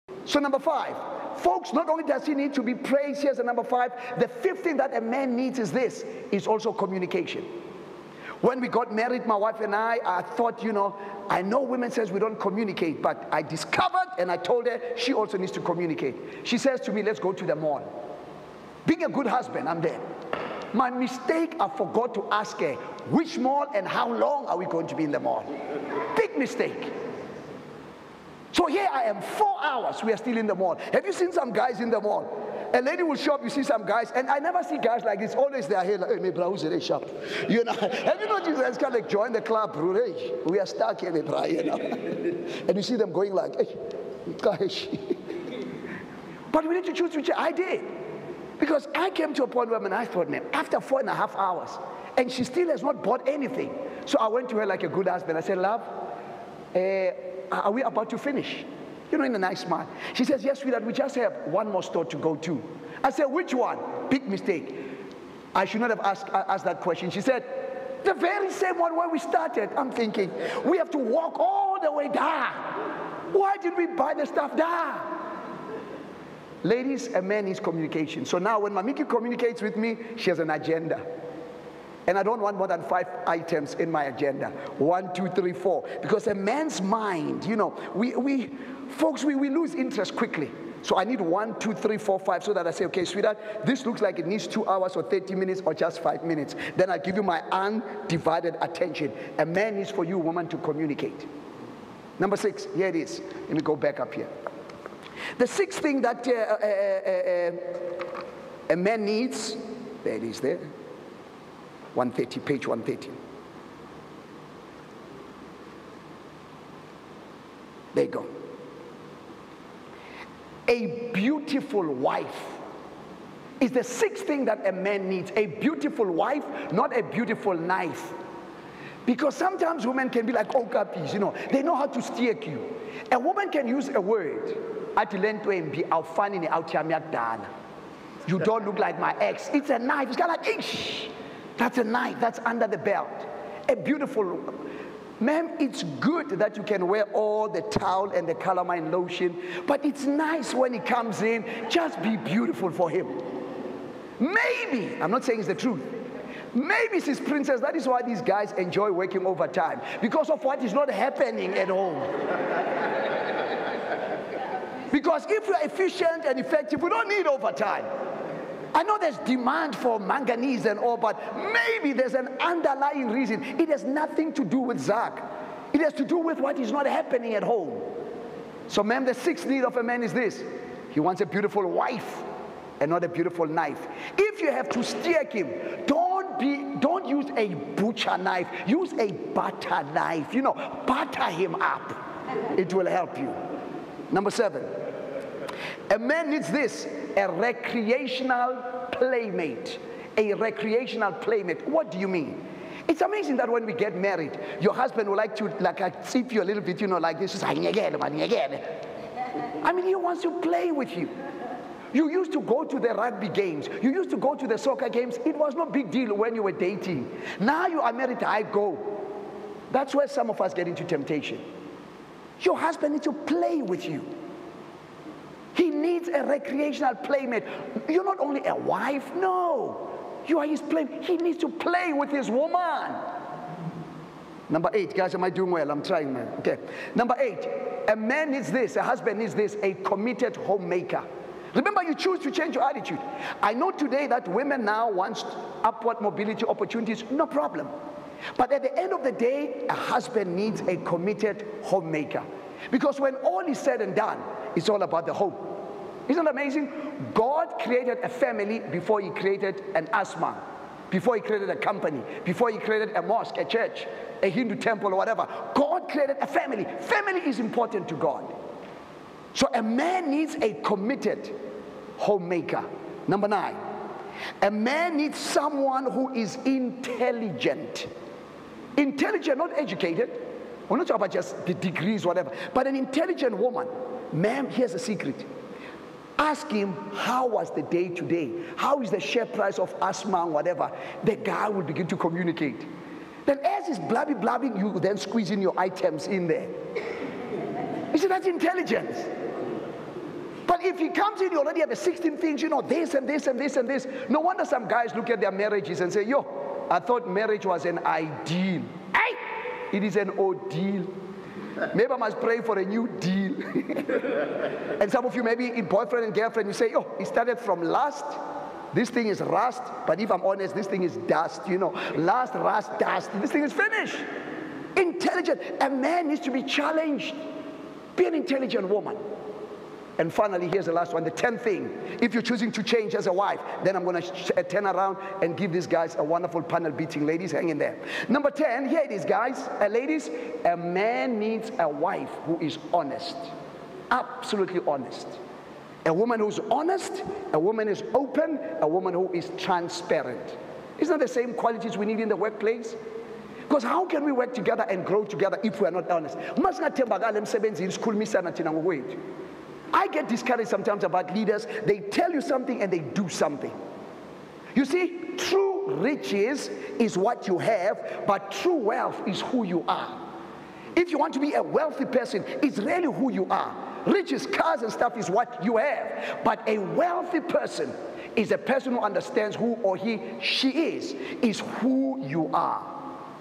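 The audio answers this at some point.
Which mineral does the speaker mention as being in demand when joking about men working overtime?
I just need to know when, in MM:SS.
02:49.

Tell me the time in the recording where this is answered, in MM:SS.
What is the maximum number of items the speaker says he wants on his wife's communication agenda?
01:22.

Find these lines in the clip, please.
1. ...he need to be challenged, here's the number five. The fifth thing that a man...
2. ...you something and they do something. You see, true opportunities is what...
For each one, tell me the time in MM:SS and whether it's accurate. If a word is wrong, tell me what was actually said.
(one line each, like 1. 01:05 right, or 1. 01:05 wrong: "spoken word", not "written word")
1. 00:02 wrong: "praised", not "challenged"
2. 06:02 wrong: "riches", not "opportunities".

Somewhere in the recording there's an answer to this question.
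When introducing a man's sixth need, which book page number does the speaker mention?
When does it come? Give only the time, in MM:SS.
01:52.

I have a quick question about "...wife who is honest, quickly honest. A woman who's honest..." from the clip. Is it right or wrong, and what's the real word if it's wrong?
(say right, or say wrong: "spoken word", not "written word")
wrong: "absolutely", not "quickly".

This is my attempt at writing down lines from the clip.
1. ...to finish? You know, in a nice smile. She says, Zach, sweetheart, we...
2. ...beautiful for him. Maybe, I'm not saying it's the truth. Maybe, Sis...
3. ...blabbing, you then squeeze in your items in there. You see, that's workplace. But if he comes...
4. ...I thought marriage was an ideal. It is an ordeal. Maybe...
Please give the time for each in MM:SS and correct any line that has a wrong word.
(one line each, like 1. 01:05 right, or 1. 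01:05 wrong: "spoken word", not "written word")
1. 00:58 wrong: "Yes", not "Zach"
2. 02:32 right
3. 04:54 wrong: "intelligence", not "workplace"
4. 05:06 right.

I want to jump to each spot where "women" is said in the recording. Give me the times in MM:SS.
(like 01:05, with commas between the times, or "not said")
00:11, 02:09, 04:04.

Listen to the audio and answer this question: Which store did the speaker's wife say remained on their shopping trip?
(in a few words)
The very same one where we started.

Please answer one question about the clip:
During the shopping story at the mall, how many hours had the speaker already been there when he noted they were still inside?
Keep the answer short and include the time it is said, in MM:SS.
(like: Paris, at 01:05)
4, at 00:29.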